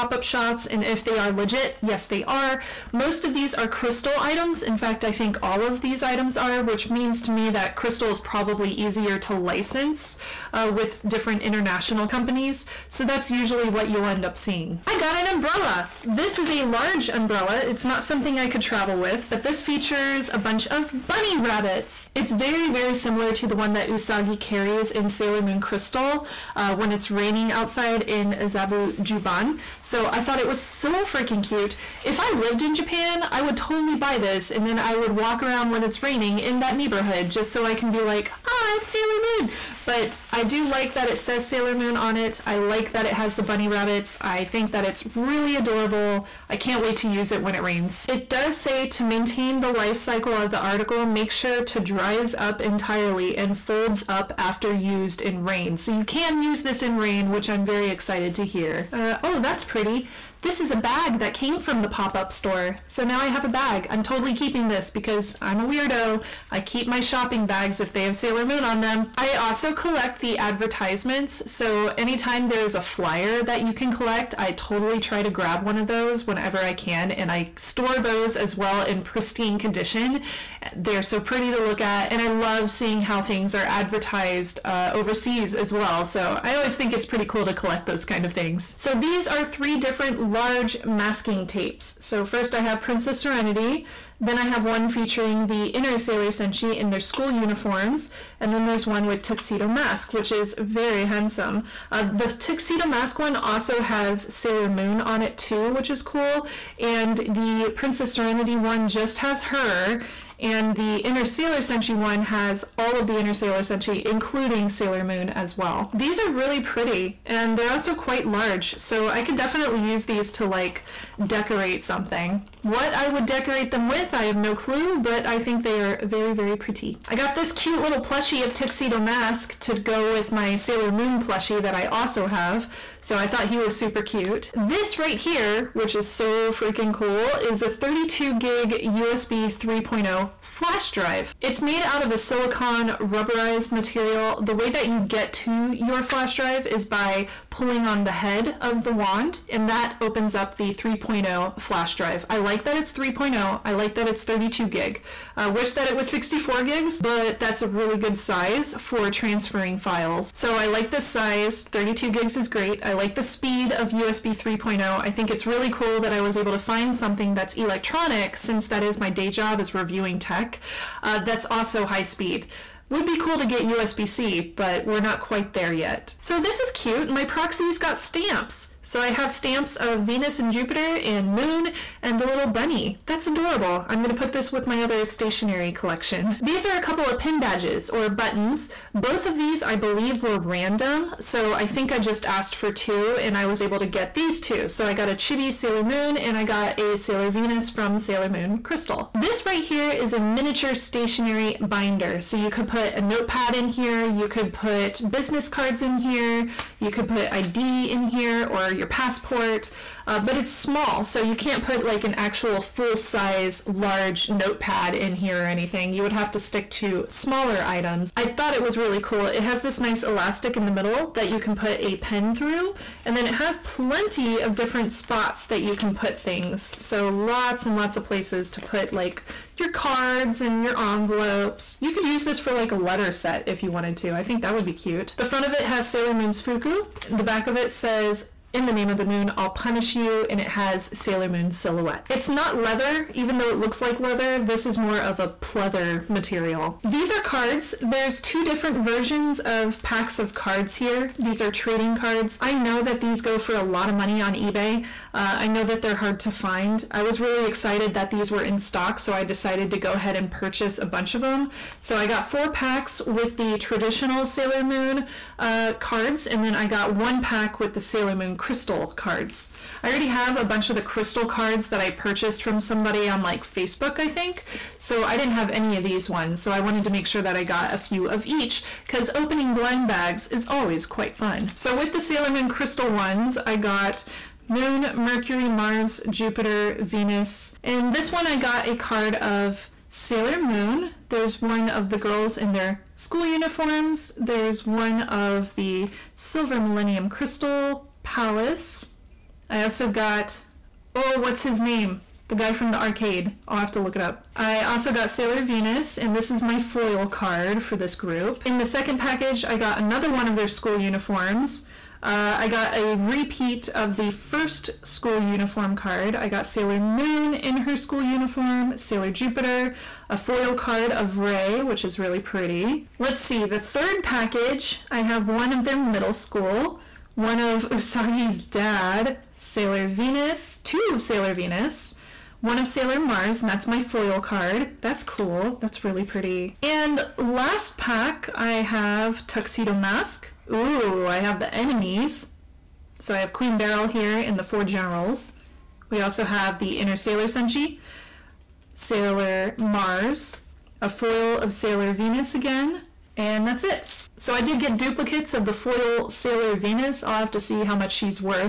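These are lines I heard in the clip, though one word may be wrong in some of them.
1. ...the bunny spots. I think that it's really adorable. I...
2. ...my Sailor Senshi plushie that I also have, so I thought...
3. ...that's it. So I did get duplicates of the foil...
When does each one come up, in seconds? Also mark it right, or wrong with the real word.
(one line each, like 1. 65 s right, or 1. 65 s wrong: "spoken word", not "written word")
1. 43 s wrong: "rabbits", not "spots"
2. 130 s wrong: "Moon", not "Senshi"
3. 353 s right.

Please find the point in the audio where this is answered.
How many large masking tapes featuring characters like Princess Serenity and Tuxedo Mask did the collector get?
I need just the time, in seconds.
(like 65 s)
89 s.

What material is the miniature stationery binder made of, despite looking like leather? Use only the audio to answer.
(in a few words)
Pleather.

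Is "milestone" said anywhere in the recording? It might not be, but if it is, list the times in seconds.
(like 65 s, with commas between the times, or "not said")
not said.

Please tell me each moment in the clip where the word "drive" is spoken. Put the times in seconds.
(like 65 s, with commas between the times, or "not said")
140 s, 146 s, 151 s.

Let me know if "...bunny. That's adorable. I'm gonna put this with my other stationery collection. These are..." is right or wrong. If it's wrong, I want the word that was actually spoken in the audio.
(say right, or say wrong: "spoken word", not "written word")
right.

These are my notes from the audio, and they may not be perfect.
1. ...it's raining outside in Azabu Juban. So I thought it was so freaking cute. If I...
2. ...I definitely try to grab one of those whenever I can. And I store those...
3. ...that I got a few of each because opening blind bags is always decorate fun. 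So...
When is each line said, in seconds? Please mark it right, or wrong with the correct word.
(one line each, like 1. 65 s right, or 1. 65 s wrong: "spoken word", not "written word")
1. 26 s right
2. 74 s wrong: "totally", not "definitely"
3. 277 s wrong: "quite", not "decorate".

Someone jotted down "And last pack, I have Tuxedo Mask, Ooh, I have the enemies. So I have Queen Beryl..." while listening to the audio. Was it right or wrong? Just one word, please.
right.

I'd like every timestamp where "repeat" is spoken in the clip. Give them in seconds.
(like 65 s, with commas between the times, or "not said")
312 s.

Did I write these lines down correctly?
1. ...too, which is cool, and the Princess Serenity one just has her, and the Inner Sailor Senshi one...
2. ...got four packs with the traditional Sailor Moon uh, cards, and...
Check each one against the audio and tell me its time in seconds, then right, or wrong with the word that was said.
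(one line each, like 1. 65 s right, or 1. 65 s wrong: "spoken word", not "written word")
1. 105 s right
2. 262 s right.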